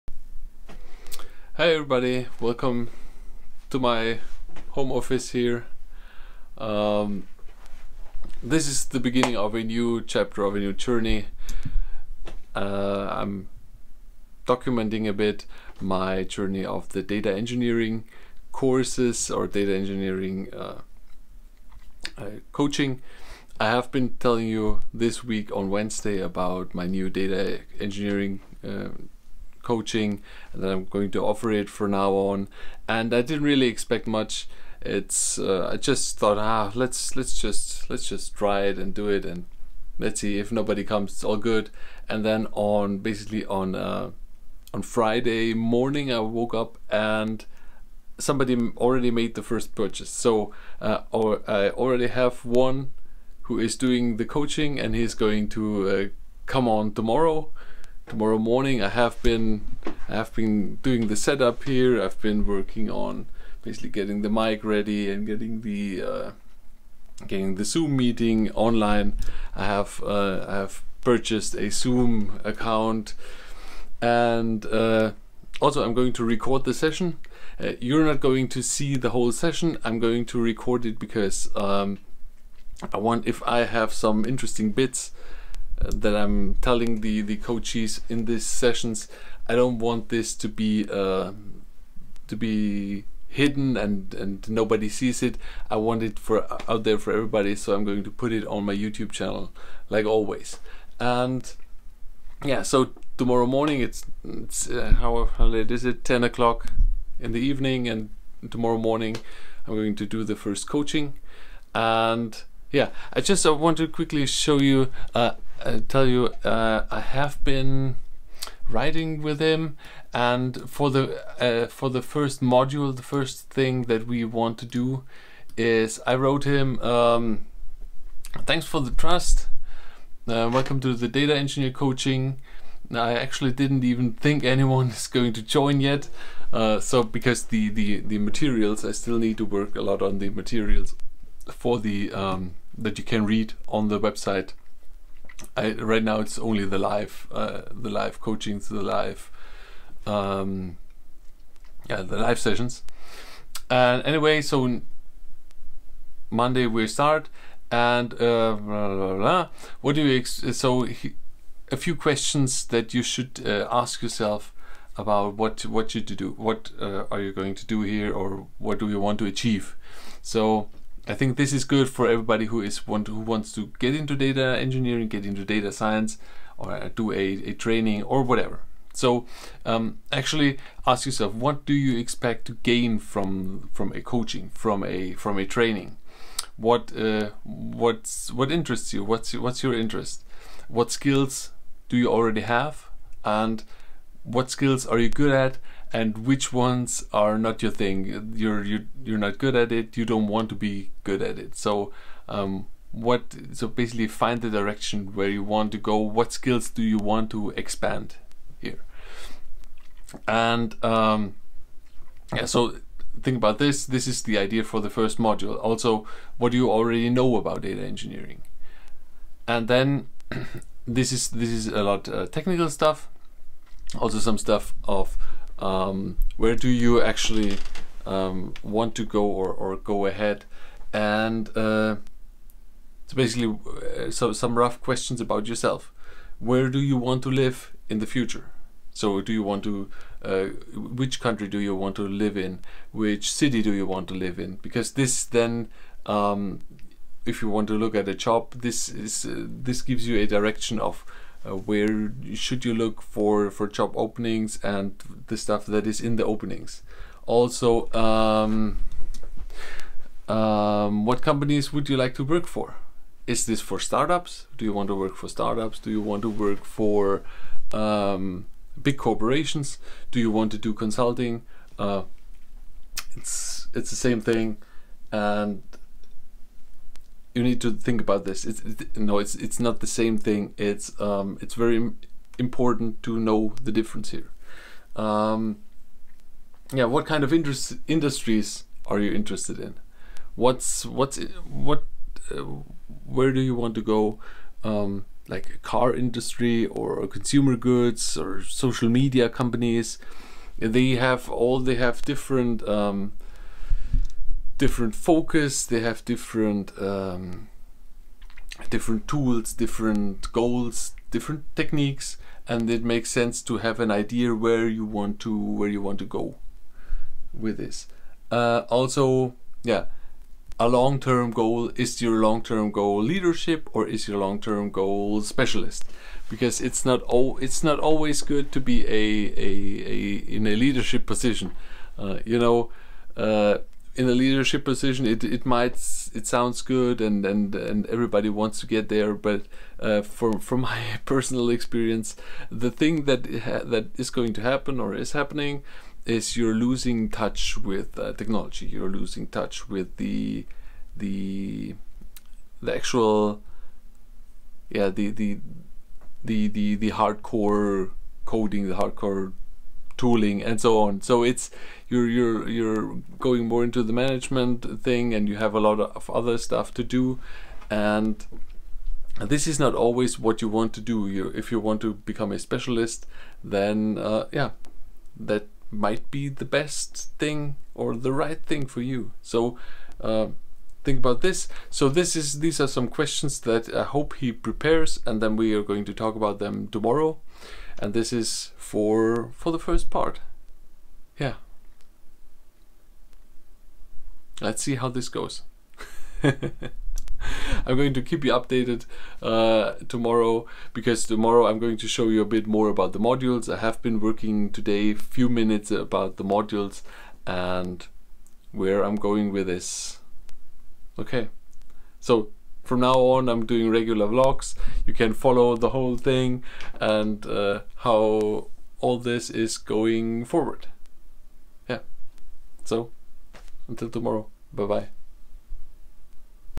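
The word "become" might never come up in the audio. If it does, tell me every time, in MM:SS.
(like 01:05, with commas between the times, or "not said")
06:11.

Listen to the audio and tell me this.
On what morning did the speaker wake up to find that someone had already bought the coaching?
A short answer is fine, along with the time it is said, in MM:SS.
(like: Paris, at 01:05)
Friday, at 00:44.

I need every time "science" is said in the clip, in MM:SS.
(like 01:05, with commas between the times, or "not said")
02:55.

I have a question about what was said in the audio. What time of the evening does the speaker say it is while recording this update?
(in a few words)
10 o'clock.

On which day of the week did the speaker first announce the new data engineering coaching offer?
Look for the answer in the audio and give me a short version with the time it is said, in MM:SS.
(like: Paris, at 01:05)
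Wednesday, at 00:25.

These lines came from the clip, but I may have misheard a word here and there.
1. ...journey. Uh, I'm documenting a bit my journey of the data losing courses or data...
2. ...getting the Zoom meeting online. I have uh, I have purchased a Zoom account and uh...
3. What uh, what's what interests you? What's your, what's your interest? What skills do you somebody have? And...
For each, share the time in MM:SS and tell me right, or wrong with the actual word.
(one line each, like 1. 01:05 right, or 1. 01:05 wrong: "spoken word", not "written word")
1. 00:10 wrong: "engineering", not "losing"
2. 01:07 right
3. 03:06 wrong: "already", not "somebody".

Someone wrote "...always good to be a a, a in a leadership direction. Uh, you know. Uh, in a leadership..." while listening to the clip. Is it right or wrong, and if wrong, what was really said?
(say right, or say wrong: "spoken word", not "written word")
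wrong: "position", not "direction".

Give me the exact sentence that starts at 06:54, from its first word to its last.
You can follow the whole thing and uh, how all this is going forward.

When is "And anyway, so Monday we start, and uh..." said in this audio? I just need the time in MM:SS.
02:33.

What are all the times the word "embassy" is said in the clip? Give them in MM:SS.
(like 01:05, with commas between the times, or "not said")
not said.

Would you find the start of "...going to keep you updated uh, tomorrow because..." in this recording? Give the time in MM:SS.
06:37.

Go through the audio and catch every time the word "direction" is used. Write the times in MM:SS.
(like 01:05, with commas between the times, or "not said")
03:24, 04:10.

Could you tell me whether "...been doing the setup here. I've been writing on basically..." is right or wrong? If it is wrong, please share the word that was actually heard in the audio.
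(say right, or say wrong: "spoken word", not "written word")
wrong: "working", not "writing".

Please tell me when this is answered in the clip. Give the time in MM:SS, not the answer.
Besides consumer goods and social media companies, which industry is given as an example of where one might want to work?
04:55.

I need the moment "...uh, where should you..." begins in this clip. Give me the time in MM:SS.
04:11.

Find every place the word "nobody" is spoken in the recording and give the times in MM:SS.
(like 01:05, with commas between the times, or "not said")
00:40, 01:34.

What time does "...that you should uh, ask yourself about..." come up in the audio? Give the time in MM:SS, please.
02:42.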